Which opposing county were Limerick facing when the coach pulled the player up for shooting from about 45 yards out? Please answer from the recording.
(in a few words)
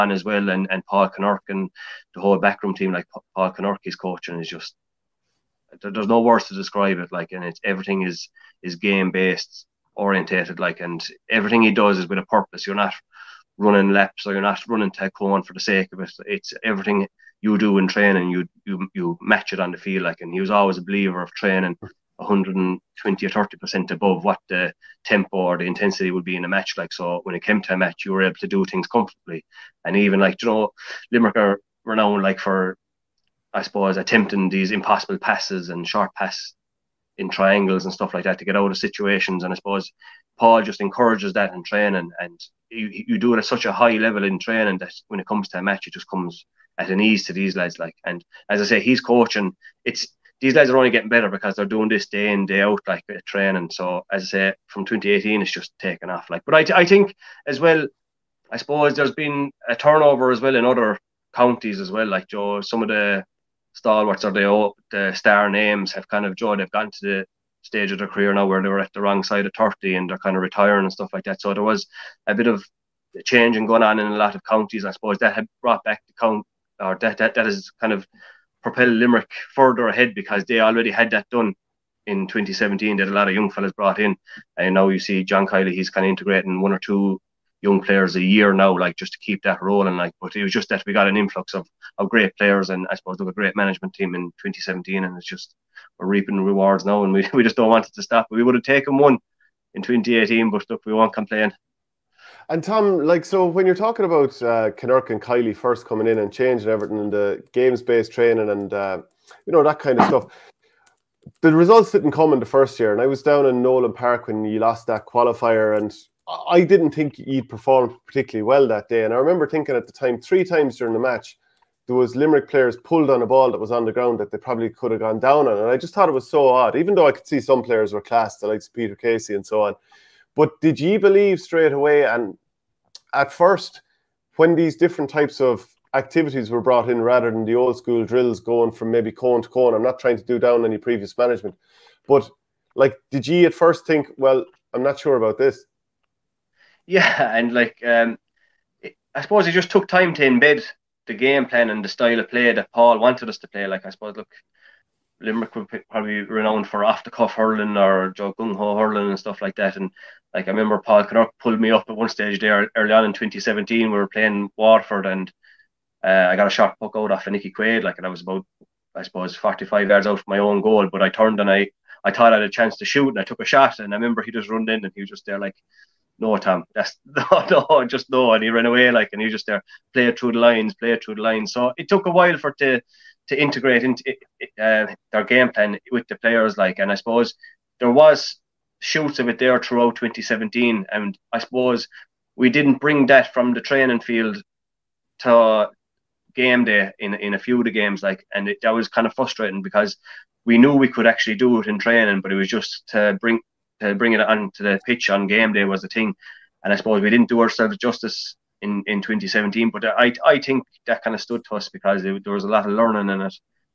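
Waterford.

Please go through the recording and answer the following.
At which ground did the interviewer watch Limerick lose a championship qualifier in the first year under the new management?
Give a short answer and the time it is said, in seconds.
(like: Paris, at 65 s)
Nolan Park, at 113 s.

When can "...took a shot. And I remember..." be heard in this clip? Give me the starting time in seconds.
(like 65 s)
173 s.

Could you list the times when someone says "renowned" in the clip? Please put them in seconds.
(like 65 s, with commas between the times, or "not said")
31 s, 156 s.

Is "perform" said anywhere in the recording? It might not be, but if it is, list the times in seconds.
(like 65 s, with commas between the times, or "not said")
117 s.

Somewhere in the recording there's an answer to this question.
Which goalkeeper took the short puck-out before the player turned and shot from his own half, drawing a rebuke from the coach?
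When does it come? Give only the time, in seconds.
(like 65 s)
167 s.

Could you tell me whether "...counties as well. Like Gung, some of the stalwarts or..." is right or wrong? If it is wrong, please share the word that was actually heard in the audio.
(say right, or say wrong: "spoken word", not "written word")
wrong: "Joe", not "Gung".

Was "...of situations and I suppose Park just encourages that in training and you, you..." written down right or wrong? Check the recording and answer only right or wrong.
wrong.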